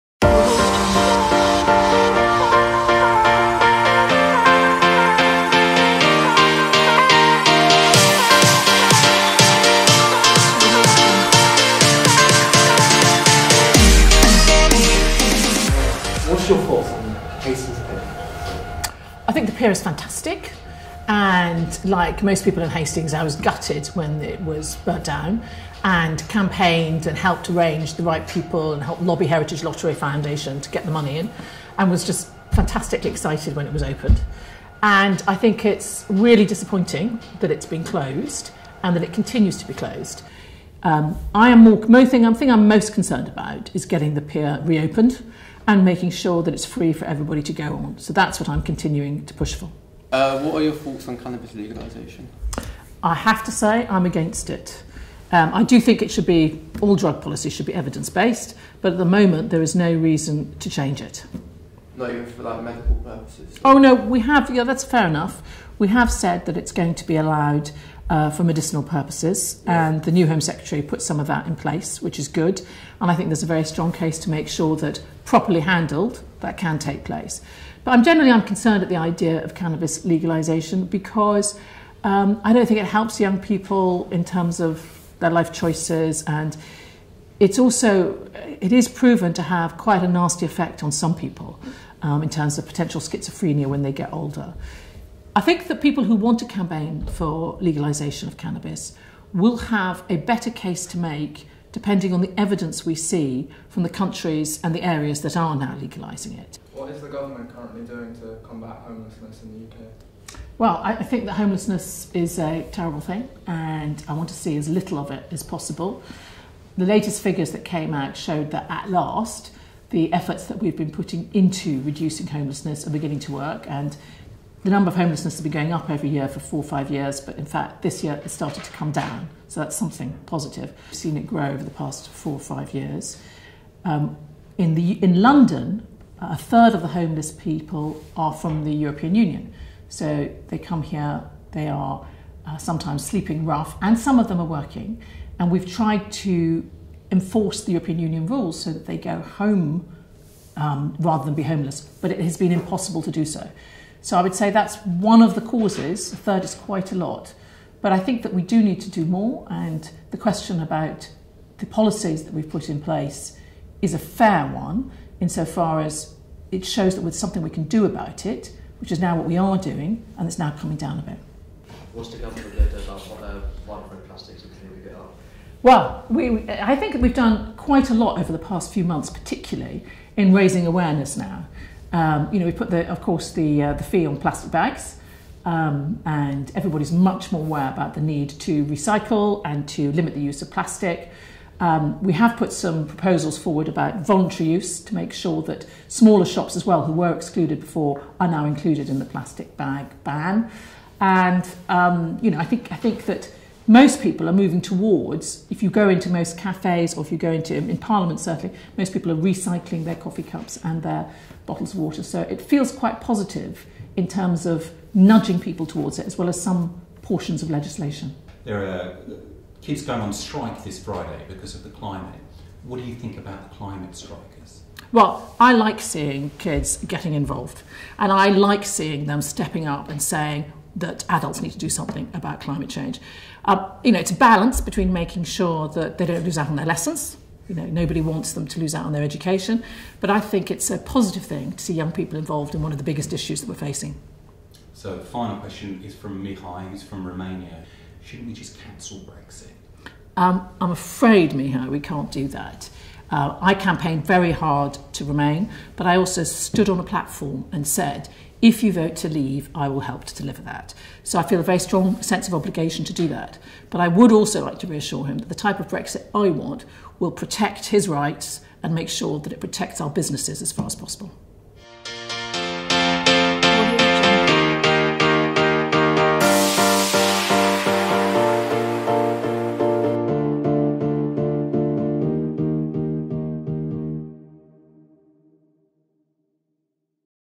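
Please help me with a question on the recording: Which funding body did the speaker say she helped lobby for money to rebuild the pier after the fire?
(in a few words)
Heritage Lottery Foundation.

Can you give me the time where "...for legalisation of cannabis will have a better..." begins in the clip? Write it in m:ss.
1:37.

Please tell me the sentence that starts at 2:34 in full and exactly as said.
So I would say that's one of the causes.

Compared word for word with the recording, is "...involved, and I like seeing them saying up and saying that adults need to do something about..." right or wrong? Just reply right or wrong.
wrong.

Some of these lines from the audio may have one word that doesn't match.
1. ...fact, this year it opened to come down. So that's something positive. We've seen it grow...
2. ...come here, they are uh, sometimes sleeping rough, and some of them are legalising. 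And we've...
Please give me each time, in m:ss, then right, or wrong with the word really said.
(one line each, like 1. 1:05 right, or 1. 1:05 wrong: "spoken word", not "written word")
1. 2:07 wrong: "started", not "opened"
2. 2:20 wrong: "working", not "legalising".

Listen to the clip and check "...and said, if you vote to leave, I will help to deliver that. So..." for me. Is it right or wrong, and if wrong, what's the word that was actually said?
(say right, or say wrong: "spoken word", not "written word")
right.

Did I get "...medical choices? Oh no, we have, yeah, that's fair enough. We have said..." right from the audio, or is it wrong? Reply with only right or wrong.
wrong.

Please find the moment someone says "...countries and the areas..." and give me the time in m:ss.
1:43.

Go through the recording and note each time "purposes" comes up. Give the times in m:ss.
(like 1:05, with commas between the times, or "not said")
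1:02, 1:08.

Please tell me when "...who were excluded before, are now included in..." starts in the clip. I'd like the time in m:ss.
3:16.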